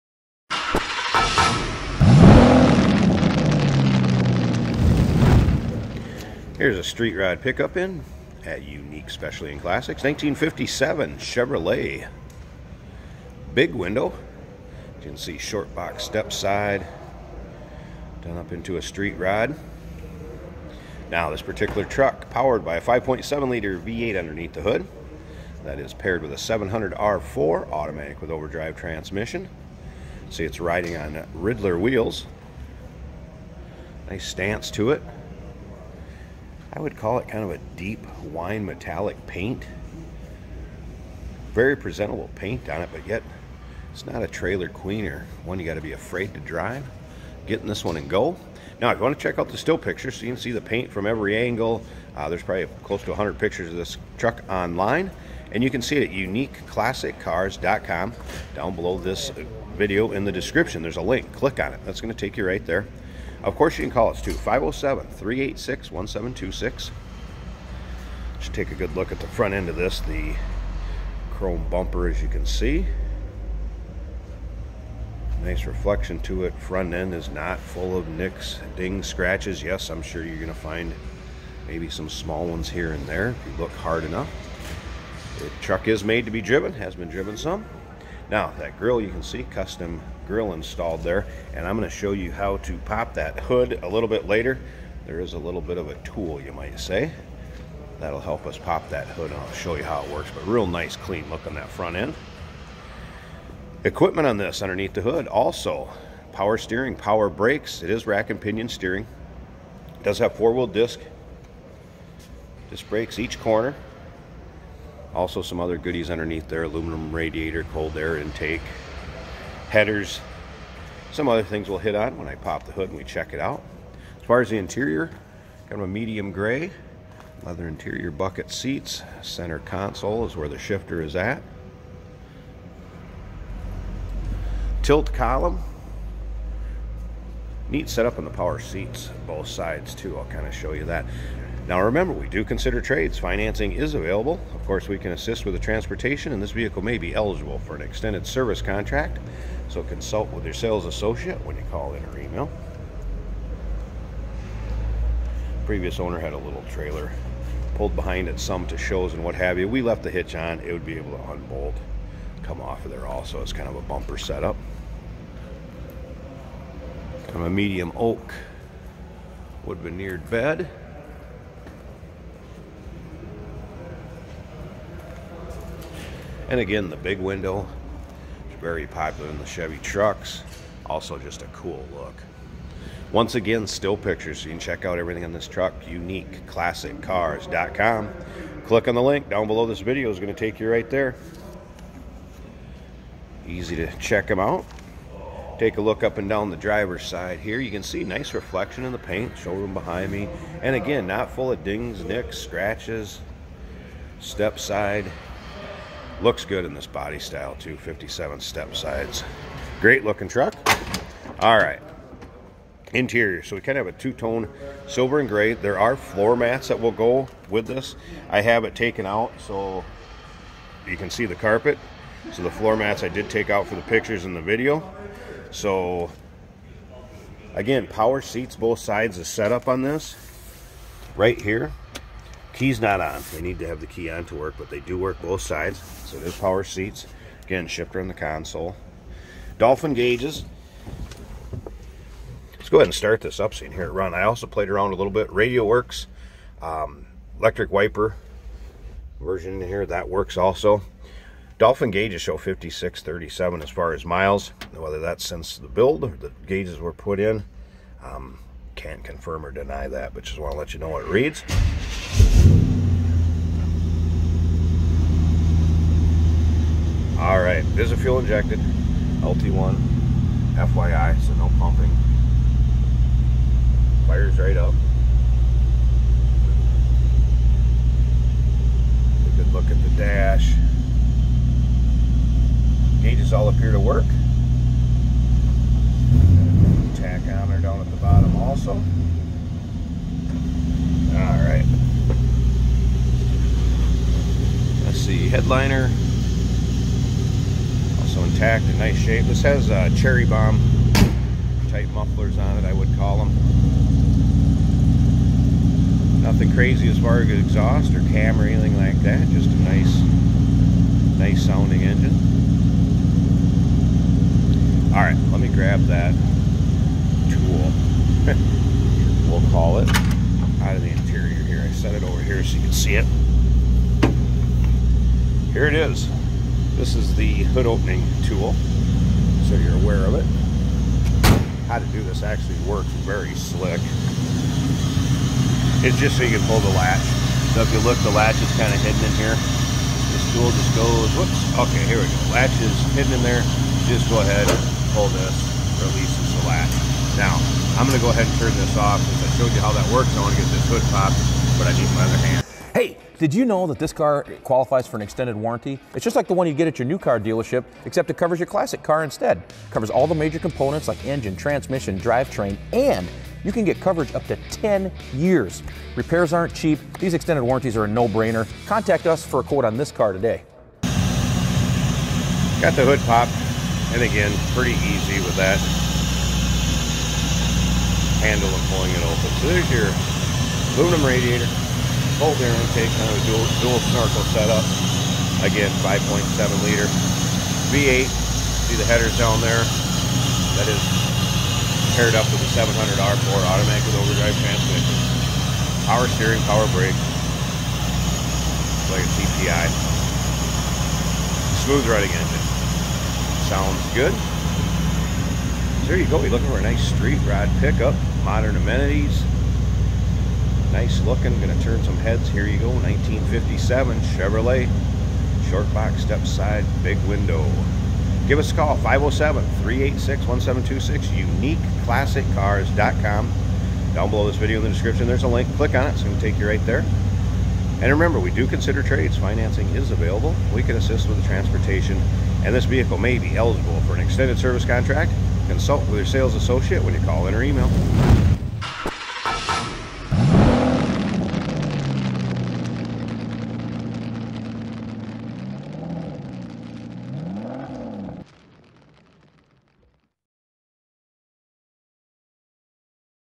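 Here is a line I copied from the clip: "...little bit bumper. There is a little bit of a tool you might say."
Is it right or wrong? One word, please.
wrong.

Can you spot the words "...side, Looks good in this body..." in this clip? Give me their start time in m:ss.
3:24.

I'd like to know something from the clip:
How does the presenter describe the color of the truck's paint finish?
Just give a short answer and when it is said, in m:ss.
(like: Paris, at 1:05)
Deep wine metallic, at 0:37.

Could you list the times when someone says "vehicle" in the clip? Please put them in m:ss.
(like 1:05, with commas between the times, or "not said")
2:26, 7:12.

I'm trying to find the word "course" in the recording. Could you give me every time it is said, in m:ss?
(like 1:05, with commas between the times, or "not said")
1:03, 2:24.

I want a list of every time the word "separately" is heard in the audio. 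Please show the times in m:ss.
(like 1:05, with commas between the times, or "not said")
not said.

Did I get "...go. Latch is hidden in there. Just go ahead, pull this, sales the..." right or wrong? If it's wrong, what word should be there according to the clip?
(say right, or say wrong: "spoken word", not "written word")
wrong: "releases", not "sales".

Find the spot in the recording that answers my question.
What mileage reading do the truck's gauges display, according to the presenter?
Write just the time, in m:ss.
4:12.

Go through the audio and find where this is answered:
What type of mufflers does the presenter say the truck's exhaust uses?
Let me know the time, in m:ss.
4:59.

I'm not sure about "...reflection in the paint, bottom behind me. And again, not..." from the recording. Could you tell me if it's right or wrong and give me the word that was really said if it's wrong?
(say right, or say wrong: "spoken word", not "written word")
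wrong: "showroom", not "bottom".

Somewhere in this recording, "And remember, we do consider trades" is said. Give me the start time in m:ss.
7:07.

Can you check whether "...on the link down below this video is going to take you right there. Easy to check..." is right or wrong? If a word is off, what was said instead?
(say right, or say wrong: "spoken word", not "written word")
right.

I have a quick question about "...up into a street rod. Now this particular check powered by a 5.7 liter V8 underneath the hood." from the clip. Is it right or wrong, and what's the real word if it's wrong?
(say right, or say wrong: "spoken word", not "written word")
wrong: "truck", not "check".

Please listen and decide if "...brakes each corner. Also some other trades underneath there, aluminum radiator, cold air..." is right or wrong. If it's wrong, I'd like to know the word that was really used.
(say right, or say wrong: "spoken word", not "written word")
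wrong: "goodies", not "trades".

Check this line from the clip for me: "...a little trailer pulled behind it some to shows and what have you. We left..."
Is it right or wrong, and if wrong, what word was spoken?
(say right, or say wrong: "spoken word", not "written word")
right.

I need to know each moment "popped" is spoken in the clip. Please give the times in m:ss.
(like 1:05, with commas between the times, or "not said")
5:50, 6:13.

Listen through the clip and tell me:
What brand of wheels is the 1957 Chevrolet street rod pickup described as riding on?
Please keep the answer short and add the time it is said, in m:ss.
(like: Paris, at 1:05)
Ridler, at 0:31.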